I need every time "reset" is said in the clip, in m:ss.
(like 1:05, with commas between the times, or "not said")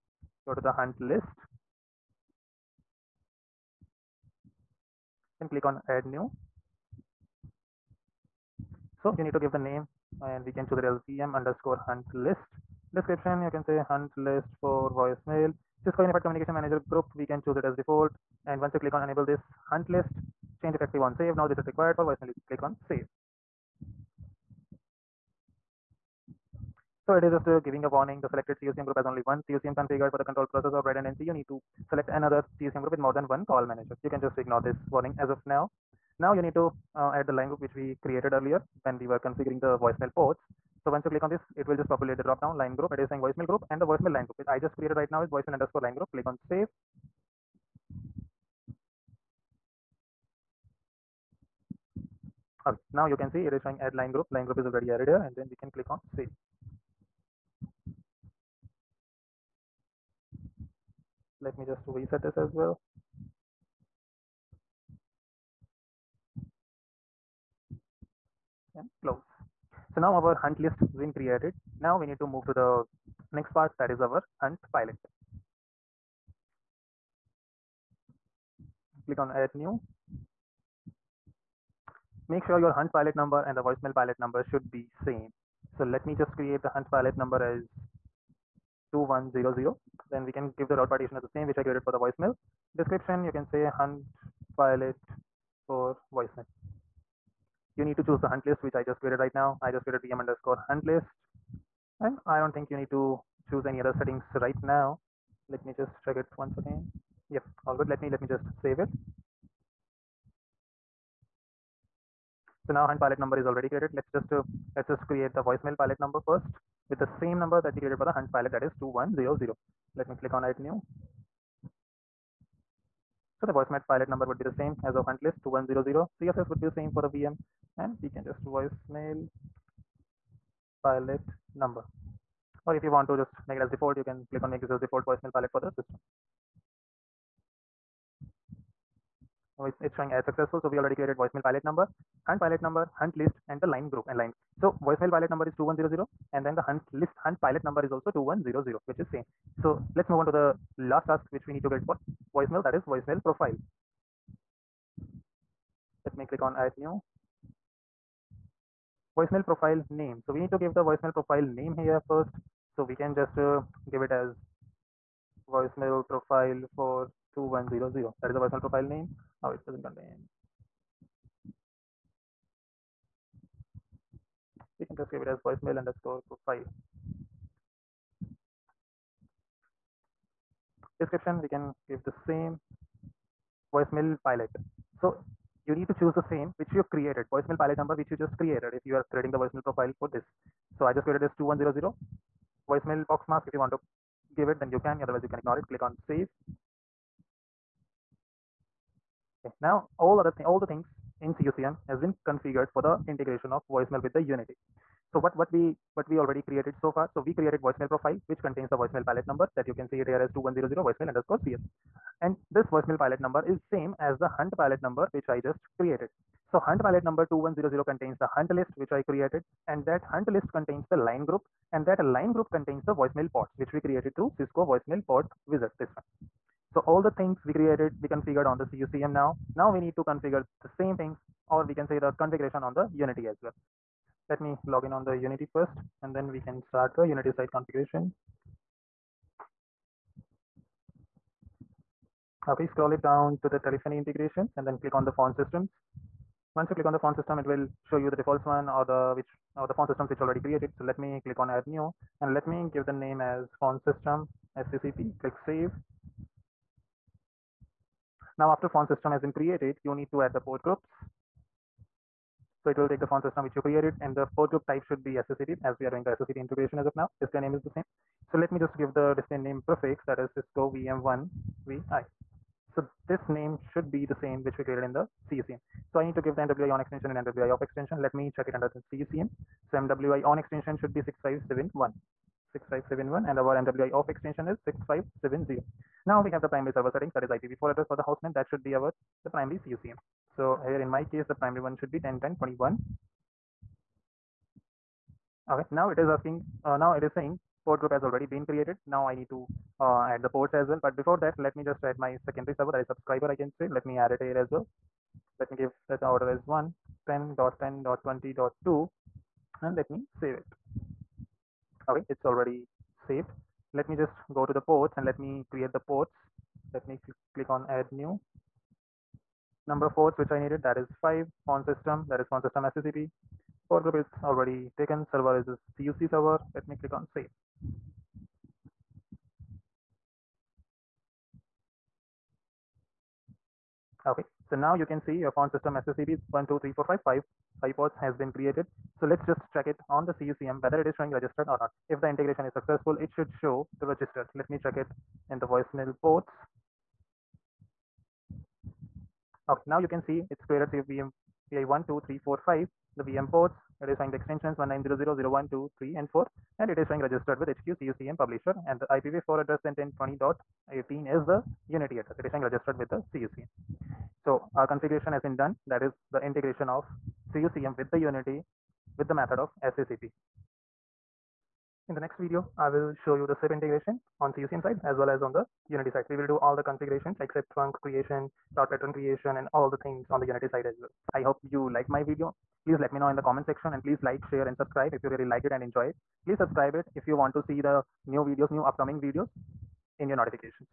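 0:21, 1:01.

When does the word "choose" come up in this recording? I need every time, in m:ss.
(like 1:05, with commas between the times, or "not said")
0:10, 0:17, 1:38, 1:43, 3:05.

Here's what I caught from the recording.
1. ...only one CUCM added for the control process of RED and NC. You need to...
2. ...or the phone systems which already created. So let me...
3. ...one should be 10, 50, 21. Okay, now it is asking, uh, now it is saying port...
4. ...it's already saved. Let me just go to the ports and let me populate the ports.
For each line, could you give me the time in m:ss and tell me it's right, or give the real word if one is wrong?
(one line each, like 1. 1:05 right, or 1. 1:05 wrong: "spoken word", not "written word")
1. 0:29 wrong: "configured", not "added"
2. 4:09 right
3. 4:51 wrong: "10", not "50"
4. 5:12 wrong: "create", not "populate".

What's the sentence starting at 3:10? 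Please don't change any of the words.
So I just created this 2100 voicemail box mask.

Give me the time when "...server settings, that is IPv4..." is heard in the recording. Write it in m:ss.
4:46.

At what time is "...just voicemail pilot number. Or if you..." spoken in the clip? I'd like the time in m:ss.
2:08.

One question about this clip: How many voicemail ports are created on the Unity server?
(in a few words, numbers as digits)
5.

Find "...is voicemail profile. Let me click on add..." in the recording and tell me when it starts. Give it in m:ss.
2:32.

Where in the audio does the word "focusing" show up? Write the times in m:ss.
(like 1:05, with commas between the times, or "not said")
not said.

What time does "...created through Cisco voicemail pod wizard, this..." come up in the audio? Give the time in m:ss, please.
3:43.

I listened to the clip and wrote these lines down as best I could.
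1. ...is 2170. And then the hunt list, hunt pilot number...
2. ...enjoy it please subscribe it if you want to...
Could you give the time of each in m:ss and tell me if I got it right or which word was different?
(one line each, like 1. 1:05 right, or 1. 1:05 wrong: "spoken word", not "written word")
1. 2:25 wrong: "2100", not "2170"
2. 6:25 right.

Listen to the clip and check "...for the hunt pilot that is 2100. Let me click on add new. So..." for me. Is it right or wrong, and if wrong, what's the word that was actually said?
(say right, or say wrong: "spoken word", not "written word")
right.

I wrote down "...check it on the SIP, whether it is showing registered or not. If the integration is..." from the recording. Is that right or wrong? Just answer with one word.
wrong.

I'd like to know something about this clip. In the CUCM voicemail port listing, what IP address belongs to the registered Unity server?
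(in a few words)
10.10.20.18.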